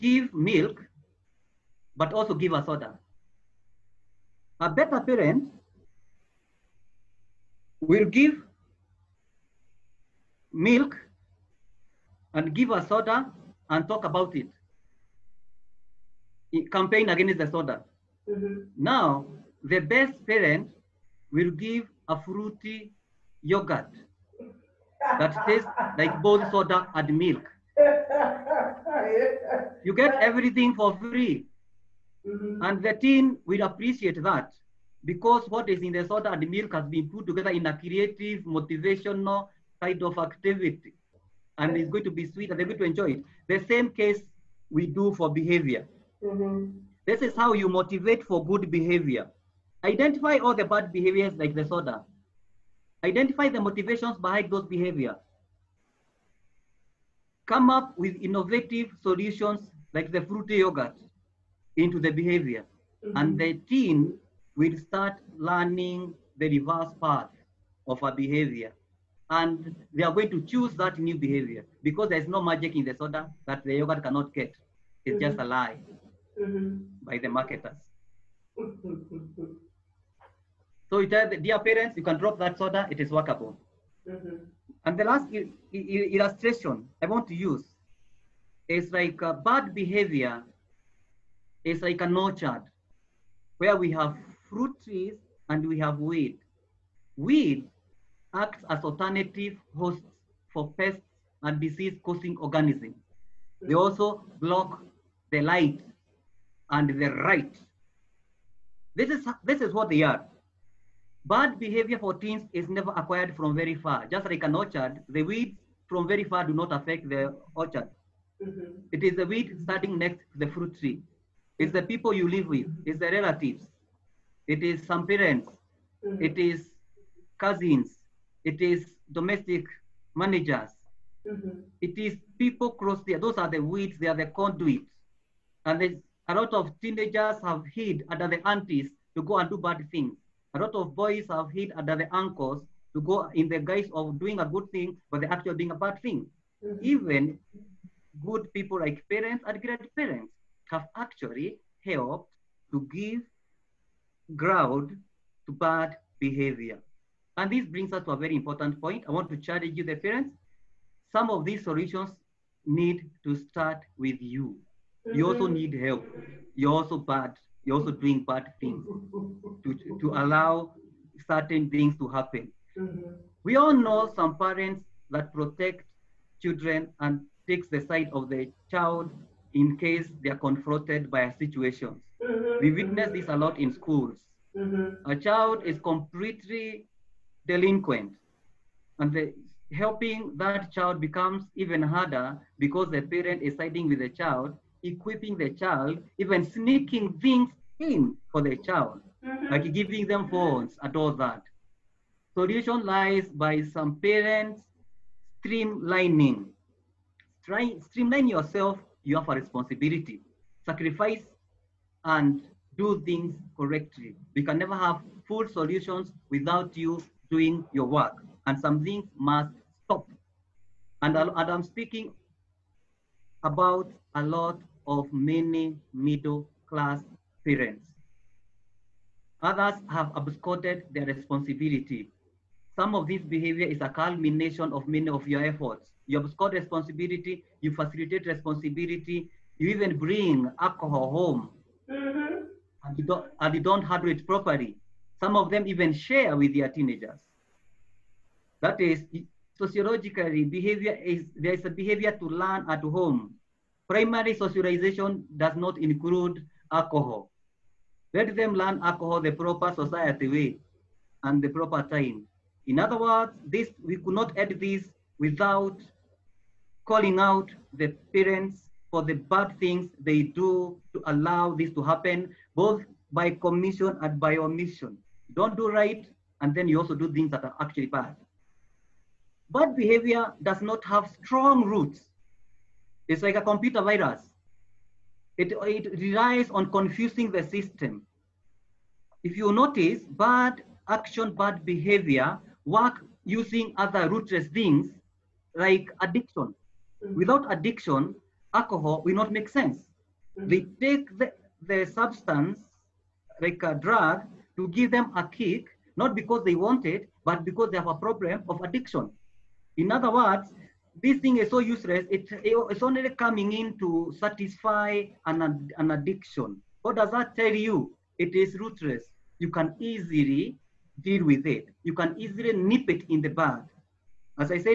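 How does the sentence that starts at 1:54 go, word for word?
Just like an orchard, the weeds from very far do not affect the orchard.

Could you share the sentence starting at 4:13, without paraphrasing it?
Primary socialization does not include alcohol.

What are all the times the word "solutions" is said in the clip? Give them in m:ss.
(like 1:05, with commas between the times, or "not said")
0:59, 2:41, 3:22, 3:35.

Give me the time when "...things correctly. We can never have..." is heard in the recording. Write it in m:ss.
3:33.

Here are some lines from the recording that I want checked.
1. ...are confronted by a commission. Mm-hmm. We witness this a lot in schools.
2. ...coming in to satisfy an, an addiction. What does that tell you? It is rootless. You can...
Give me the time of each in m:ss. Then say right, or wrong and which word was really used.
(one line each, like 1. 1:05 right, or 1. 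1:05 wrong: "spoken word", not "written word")
1. 3:00 wrong: "situation", not "commission"
2. 5:13 right.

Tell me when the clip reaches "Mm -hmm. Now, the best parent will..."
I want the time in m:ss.
0:18.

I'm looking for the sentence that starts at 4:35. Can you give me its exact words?
Don't do right, and then you also do things that are actually bad.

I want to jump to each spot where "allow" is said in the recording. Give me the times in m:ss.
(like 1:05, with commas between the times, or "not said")
2:50, 4:31.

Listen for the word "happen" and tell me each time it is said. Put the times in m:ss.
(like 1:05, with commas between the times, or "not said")
2:52, 4:31.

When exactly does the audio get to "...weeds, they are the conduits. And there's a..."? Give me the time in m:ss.
2:13.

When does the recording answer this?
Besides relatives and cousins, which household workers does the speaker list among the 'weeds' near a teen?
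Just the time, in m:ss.
2:09.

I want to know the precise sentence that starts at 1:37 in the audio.
Weed acts as alternative hosts for pests and disease-causing organisms.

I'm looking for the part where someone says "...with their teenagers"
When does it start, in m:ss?
4:06.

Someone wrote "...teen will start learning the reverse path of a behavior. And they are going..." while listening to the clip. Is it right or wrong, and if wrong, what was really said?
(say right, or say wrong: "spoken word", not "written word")
right.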